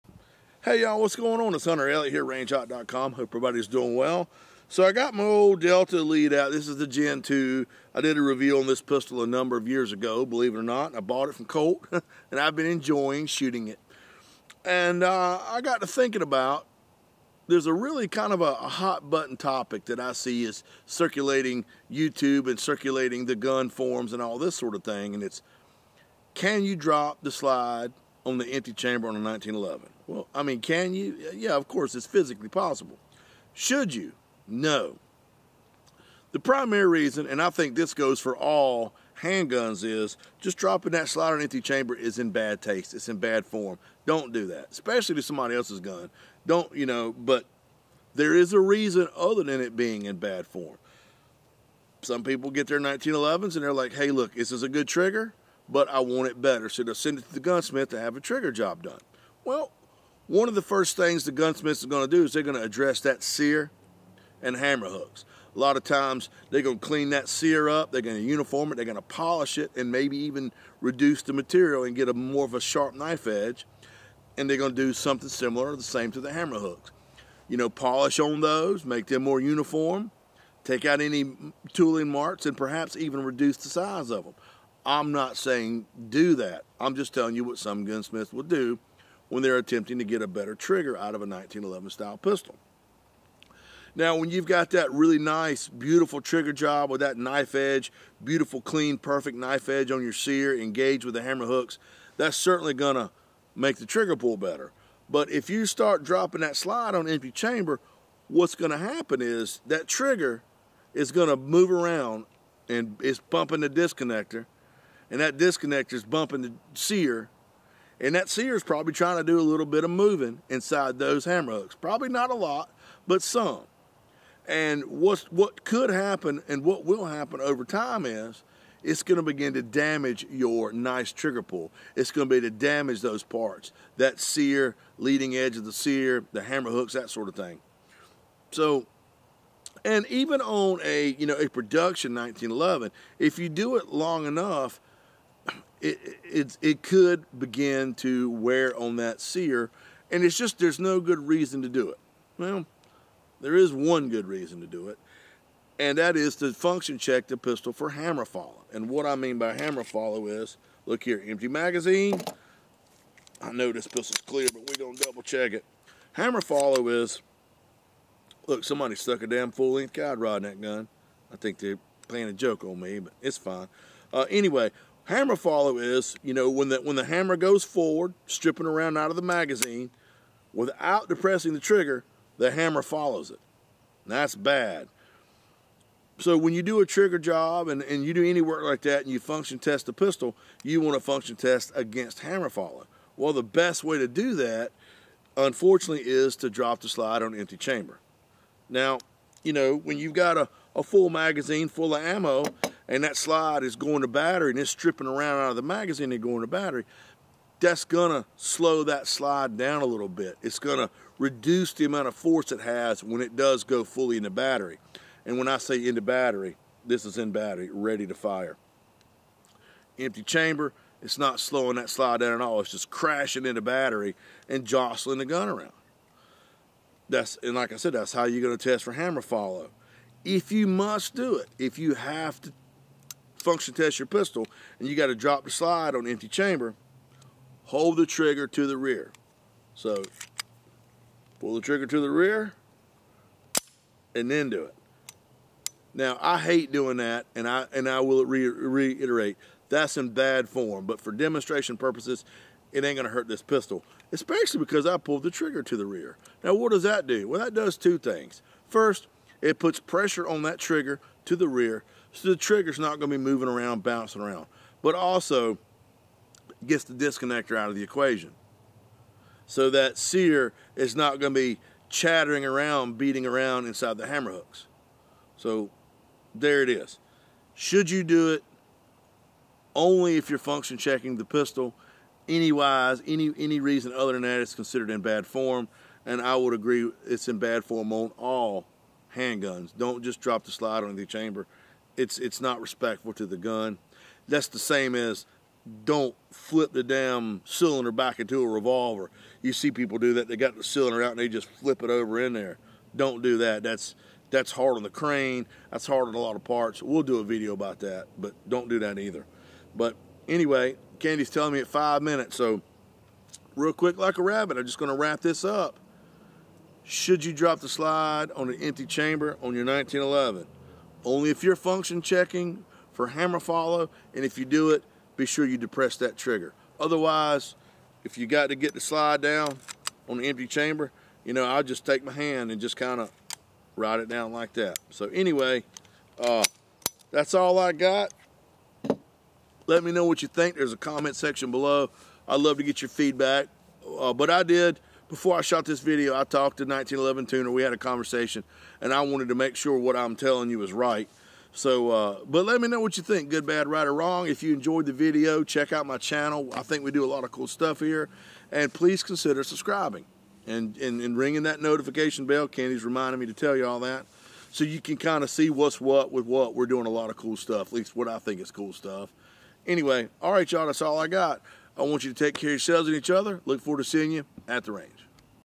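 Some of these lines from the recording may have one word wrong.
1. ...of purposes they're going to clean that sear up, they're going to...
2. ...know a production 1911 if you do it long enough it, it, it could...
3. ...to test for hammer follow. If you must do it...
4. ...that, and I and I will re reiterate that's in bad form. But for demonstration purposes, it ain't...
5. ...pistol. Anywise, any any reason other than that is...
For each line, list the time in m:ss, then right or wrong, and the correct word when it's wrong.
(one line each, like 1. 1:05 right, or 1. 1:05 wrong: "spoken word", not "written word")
1. 1:05 wrong: "times", not "purposes"
2. 2:21 right
3. 3:48 right
4. 4:06 right
5. 4:41 right.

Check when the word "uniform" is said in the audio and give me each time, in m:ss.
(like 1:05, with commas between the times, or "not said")
1:08, 1:19.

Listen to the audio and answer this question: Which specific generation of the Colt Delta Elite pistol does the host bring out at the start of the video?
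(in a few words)
Gen 2.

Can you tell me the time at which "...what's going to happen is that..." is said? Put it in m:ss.
1:48.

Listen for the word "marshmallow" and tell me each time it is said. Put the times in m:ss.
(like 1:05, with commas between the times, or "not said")
not said.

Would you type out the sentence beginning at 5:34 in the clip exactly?
So anyway, uh, that's all I got.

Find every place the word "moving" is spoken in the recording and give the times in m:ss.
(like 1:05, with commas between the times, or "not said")
1:59, 4:23.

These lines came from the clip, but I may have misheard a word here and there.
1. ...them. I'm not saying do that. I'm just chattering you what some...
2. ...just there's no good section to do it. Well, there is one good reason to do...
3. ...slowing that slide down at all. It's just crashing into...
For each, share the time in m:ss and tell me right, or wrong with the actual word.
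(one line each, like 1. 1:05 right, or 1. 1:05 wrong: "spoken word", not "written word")
1. 1:24 wrong: "telling", not "chattering"
2. 2:30 wrong: "reason", not "section"
3. 3:41 right.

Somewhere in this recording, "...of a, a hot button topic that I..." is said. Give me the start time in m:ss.
0:18.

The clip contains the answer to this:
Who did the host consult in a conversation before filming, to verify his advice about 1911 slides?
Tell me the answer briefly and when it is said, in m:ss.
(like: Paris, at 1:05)
1911 Tuner, at 5:46.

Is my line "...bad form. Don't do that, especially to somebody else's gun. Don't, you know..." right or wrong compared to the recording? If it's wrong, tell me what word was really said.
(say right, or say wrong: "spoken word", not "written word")
right.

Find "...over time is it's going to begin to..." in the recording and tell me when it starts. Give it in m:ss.
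2:07.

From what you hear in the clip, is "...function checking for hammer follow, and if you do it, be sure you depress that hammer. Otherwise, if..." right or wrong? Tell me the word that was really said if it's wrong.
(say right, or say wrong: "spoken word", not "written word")
wrong: "trigger", not "hammer".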